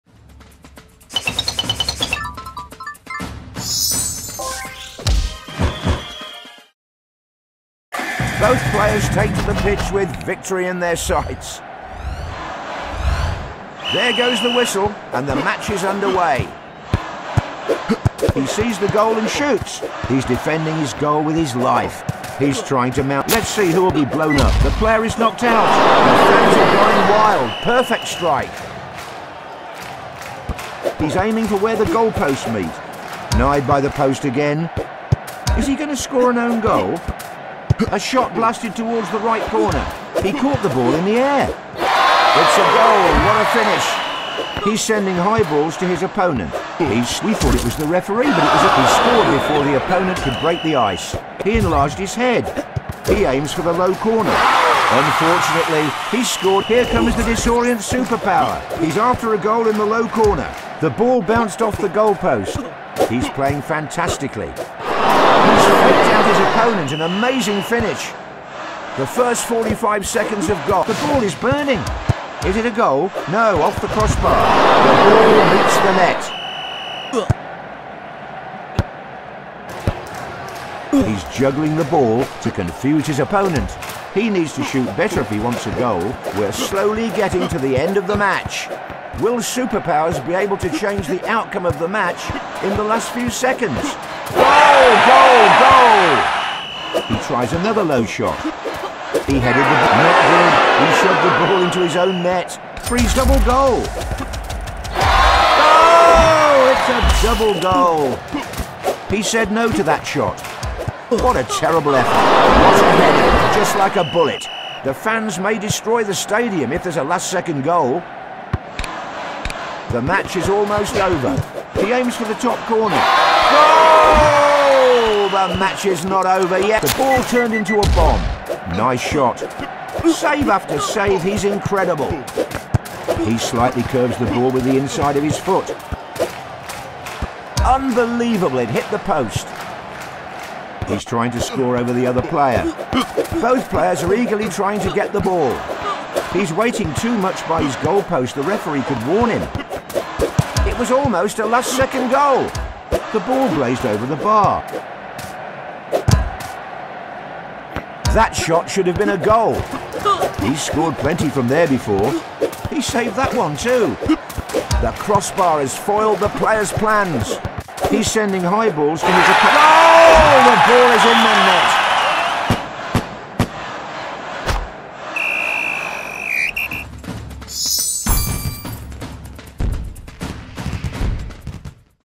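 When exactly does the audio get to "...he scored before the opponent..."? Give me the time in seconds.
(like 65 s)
48 s.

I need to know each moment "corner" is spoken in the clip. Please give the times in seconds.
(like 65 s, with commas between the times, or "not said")
39 s, 53 s, 60 s, 122 s.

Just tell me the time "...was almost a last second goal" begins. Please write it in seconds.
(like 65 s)
150 s.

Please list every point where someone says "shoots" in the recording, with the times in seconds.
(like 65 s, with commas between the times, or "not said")
19 s, 84 s.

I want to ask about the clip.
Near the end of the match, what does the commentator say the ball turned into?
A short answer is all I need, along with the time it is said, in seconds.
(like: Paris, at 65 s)
A bomb, at 127 s.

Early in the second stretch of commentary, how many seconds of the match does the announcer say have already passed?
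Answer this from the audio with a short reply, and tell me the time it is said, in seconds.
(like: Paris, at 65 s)
45, at 69 s.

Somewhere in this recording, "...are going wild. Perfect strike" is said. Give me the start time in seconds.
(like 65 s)
26 s.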